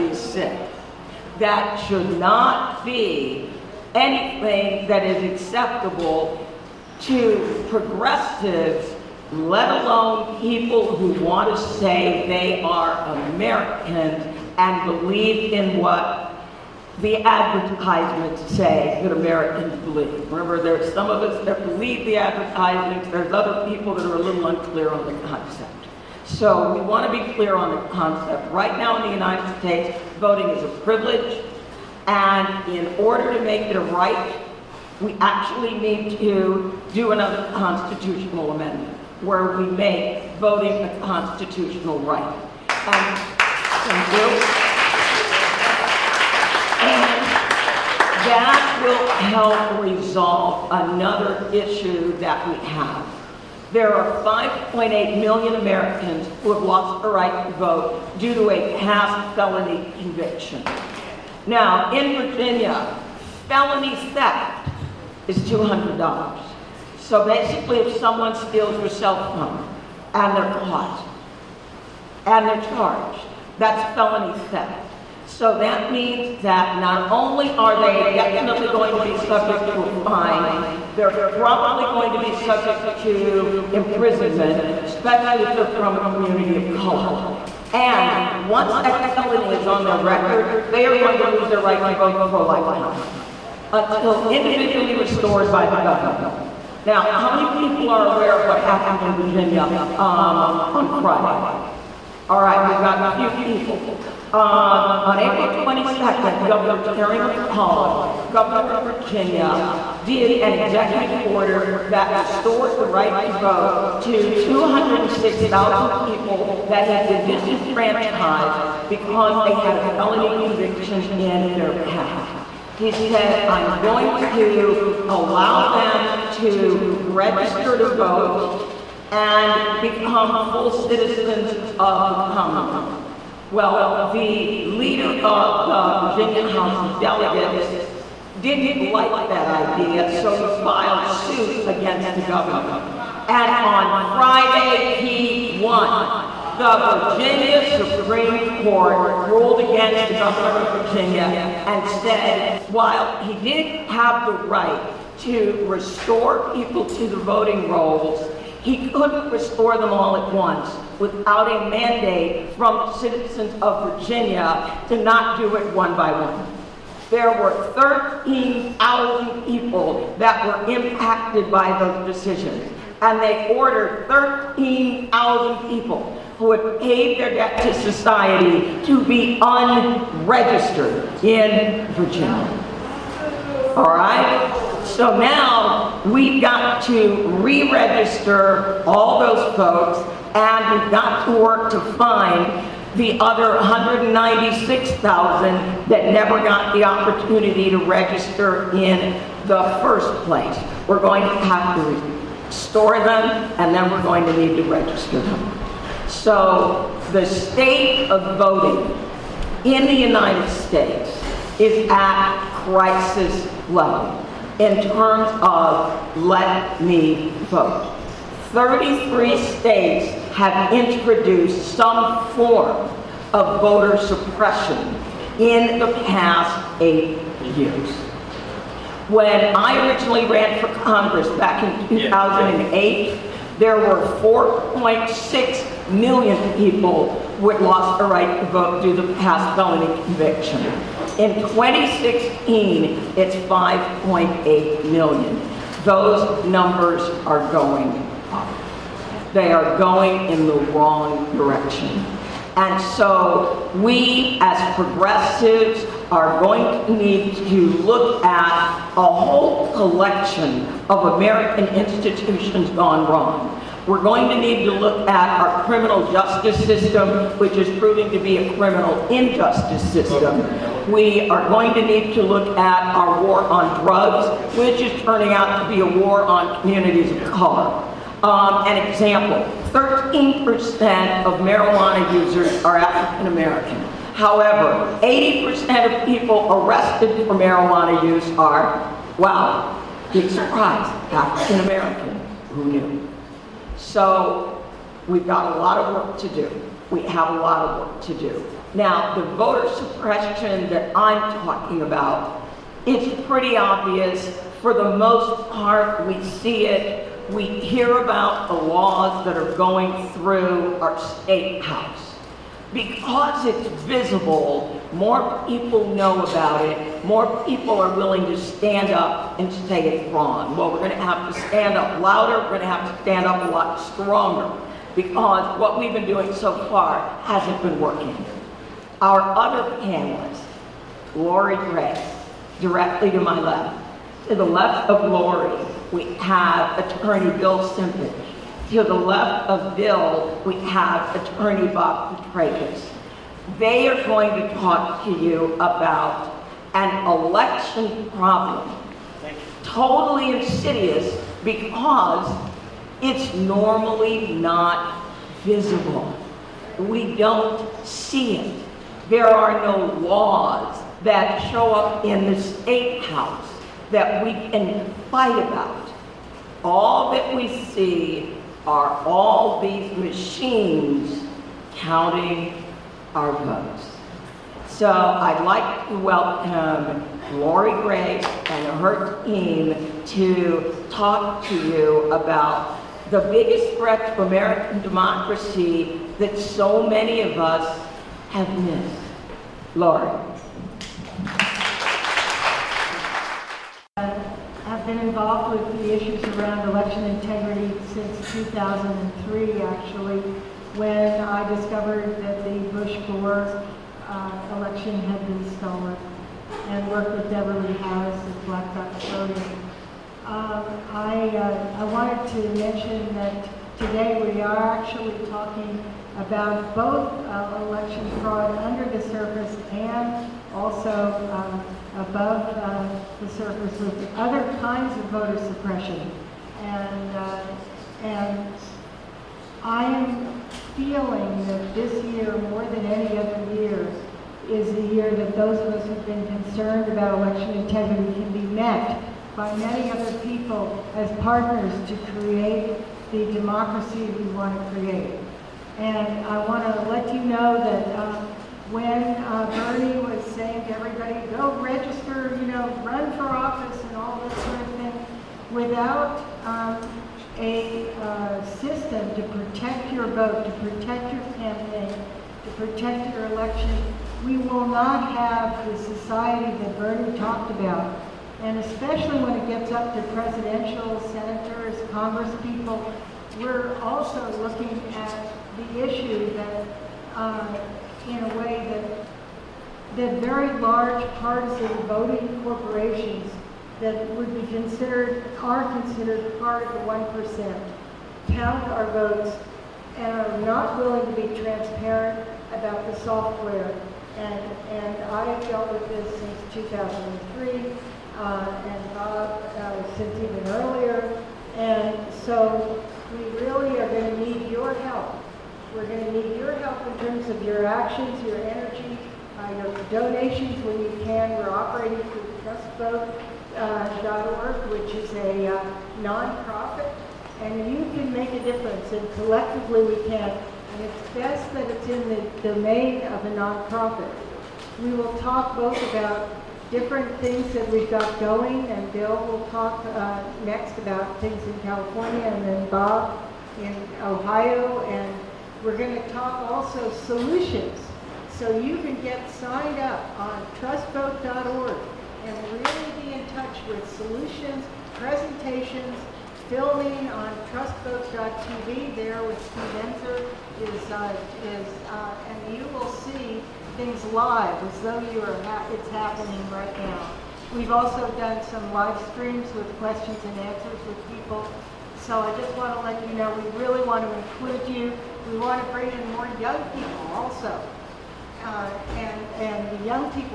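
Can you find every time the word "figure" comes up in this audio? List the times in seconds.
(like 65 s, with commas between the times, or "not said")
not said.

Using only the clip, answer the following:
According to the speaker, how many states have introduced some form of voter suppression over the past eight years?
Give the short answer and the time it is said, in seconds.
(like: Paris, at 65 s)
33, at 218 s.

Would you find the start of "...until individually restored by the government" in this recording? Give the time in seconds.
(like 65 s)
93 s.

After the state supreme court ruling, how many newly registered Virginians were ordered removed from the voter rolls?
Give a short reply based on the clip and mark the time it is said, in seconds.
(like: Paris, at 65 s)
13,000, at 174 s.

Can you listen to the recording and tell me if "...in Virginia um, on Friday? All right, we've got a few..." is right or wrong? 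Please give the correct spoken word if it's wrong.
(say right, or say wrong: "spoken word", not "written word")
right.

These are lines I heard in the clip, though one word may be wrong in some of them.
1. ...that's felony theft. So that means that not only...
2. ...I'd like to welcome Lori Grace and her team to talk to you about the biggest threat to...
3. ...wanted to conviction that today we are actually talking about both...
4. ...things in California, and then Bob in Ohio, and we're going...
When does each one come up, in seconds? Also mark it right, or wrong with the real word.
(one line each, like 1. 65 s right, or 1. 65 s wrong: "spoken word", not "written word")
1. 73 s right
2. 374 s right
3. 411 s wrong: "mention", not "conviction"
4. 531 s right.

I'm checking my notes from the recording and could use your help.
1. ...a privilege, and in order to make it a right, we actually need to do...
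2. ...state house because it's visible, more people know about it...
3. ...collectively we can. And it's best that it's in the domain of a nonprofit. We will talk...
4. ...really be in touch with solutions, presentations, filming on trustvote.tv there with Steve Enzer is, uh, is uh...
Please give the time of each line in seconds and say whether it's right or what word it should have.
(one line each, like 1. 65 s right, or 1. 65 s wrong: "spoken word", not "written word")
1. 30 s right
2. 310 s right
3. 519 s right
4. 542 s right.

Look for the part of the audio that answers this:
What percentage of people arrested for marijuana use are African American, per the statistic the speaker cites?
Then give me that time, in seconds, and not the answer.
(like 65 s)
285 s.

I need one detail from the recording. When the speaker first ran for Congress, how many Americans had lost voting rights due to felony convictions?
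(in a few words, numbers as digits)
4.6 million.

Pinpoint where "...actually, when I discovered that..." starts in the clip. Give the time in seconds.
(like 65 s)
399 s.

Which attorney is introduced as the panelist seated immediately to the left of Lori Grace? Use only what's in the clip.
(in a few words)
Bill Simpson.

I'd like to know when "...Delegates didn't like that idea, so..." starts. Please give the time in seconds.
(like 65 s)
136 s.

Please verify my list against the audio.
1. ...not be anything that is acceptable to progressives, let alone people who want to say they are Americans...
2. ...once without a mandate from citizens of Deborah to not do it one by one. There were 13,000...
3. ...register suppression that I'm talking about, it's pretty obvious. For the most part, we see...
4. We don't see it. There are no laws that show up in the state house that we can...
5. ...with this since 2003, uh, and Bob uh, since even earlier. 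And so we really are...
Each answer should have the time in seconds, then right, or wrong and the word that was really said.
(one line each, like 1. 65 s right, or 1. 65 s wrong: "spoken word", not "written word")
1. 2 s right
2. 160 s wrong: "Virginia", not "Deborah"
3. 299 s wrong: "voter", not "register"
4. 356 s right
5. 495 s right.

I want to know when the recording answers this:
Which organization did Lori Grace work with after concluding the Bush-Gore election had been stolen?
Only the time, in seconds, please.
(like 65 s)
408 s.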